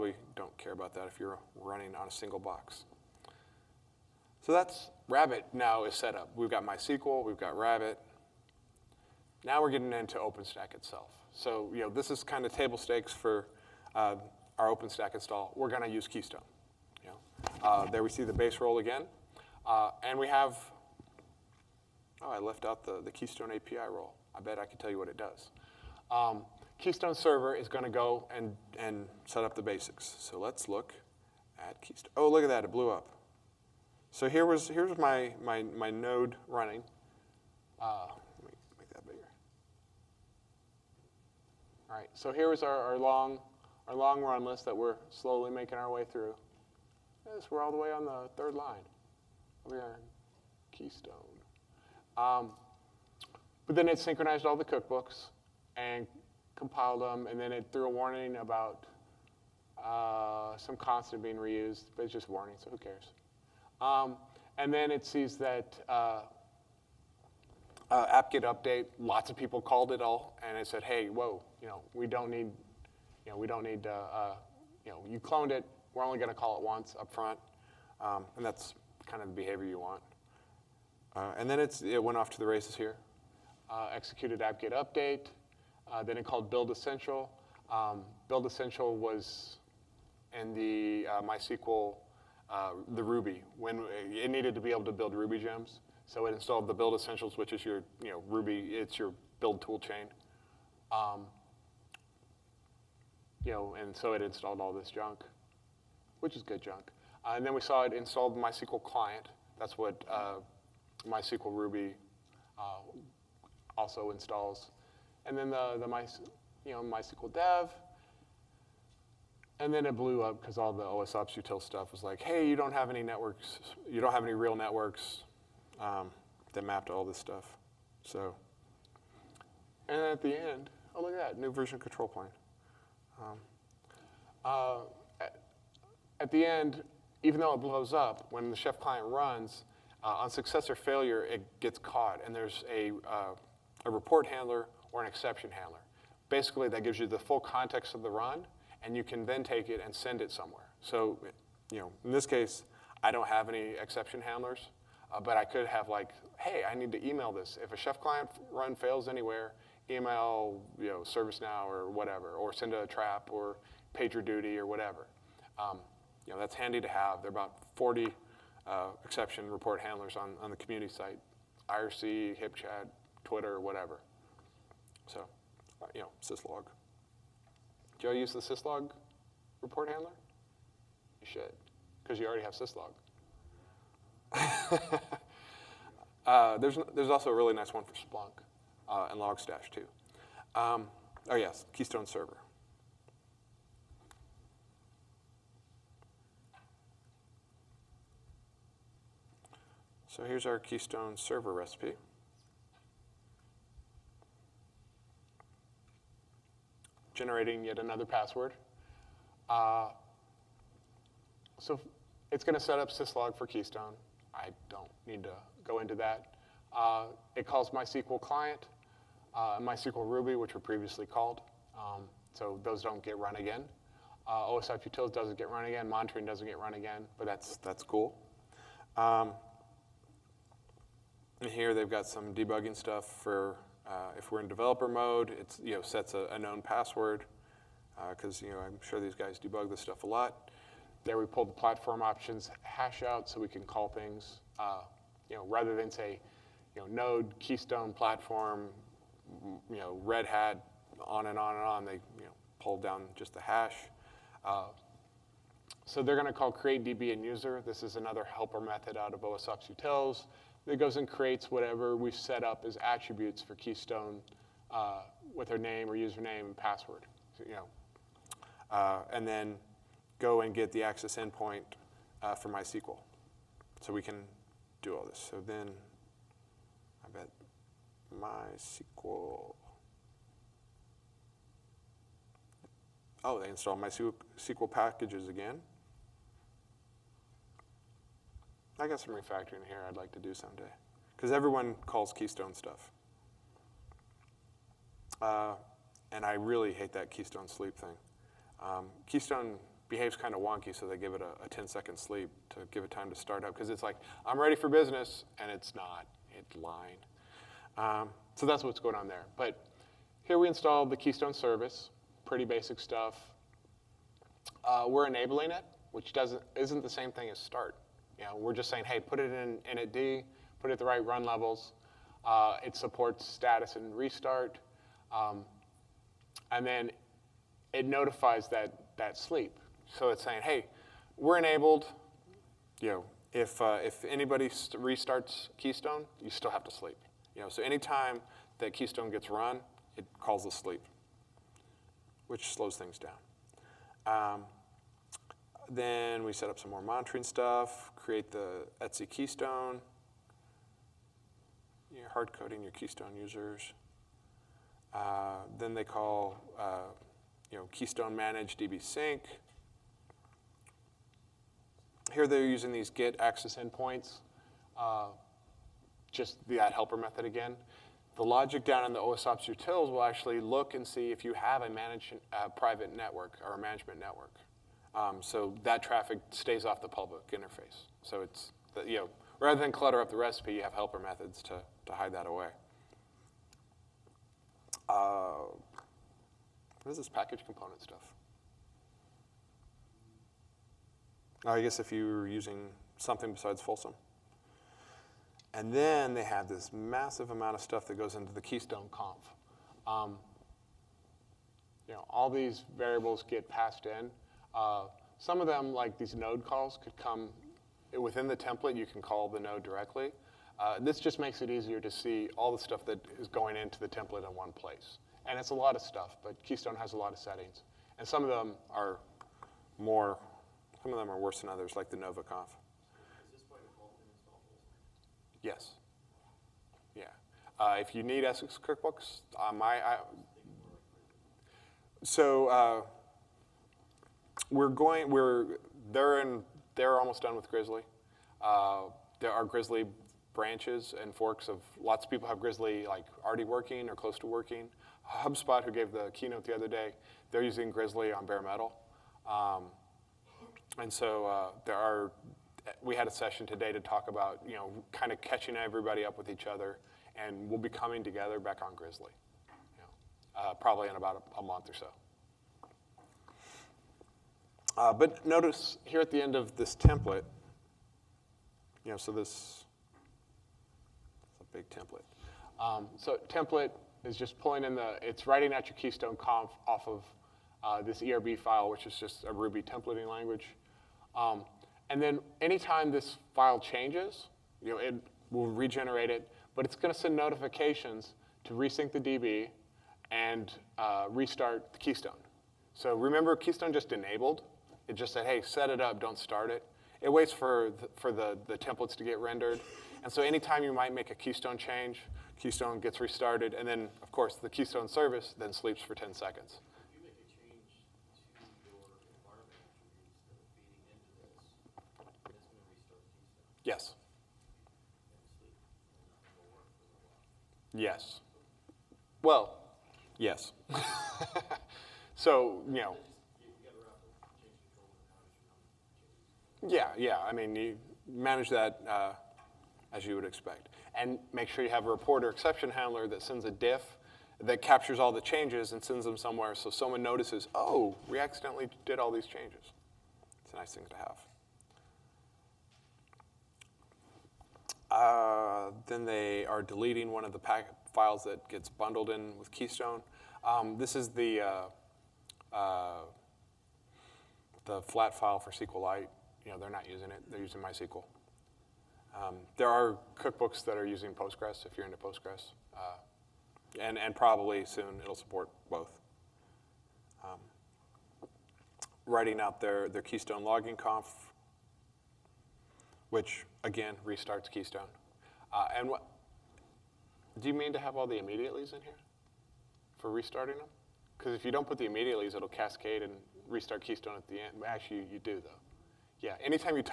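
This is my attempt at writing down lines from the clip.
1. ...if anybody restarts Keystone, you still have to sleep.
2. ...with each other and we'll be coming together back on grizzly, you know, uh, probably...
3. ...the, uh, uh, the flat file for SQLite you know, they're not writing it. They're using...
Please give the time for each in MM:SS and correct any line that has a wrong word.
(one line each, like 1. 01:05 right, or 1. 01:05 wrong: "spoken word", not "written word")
1. 05:33 right
2. 07:36 right
3. 09:11 wrong: "using", not "writing".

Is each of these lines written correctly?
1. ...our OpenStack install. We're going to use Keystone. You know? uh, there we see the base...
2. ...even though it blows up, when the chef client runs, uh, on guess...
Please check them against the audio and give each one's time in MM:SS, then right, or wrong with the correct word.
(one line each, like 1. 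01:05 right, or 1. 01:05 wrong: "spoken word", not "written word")
1. 00:14 right
2. 02:17 wrong: "success", not "guess".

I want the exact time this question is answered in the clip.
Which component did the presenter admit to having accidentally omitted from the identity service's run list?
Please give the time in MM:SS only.
00:23.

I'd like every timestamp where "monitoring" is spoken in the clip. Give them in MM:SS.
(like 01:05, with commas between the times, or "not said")
03:45, 05:46.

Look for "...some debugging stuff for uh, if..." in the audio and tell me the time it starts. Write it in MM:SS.
03:52.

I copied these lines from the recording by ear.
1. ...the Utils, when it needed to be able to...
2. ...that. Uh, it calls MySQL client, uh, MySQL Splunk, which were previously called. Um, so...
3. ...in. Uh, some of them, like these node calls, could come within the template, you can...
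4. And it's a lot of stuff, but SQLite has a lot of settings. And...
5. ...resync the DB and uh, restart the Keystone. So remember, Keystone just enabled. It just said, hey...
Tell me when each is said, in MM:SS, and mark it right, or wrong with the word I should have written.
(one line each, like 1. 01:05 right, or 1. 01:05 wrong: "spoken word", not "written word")
1. 01:32 wrong: "Ruby", not "Utils"
2. 03:35 wrong: "Ruby", not "Splunk"
3. 06:43 right
4. 06:55 wrong: "Keystone", not "SQLite"
5. 08:08 right.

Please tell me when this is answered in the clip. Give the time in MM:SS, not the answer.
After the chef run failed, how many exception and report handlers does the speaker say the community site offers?
02:47.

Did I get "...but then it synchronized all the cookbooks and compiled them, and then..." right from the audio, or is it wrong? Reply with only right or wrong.
right.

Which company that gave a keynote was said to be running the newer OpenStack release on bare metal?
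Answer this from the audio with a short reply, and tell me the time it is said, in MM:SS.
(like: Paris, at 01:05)
HubSpot, at 07:25.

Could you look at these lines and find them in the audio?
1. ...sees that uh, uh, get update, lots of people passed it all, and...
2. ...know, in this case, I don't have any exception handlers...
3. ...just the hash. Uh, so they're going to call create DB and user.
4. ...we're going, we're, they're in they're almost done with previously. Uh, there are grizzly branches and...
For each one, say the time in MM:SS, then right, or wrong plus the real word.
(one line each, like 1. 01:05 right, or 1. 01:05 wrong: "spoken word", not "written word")
1. 01:05 wrong: "called", not "passed"
2. 02:31 right
3. 04:13 right
4. 07:14 wrong: "grizzly", not "previously".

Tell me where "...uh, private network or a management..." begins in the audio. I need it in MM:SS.
06:12.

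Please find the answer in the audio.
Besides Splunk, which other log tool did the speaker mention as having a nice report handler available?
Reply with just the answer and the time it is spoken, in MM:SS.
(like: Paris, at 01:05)
Logstash, at 03:09.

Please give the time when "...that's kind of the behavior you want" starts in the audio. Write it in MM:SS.
01:18.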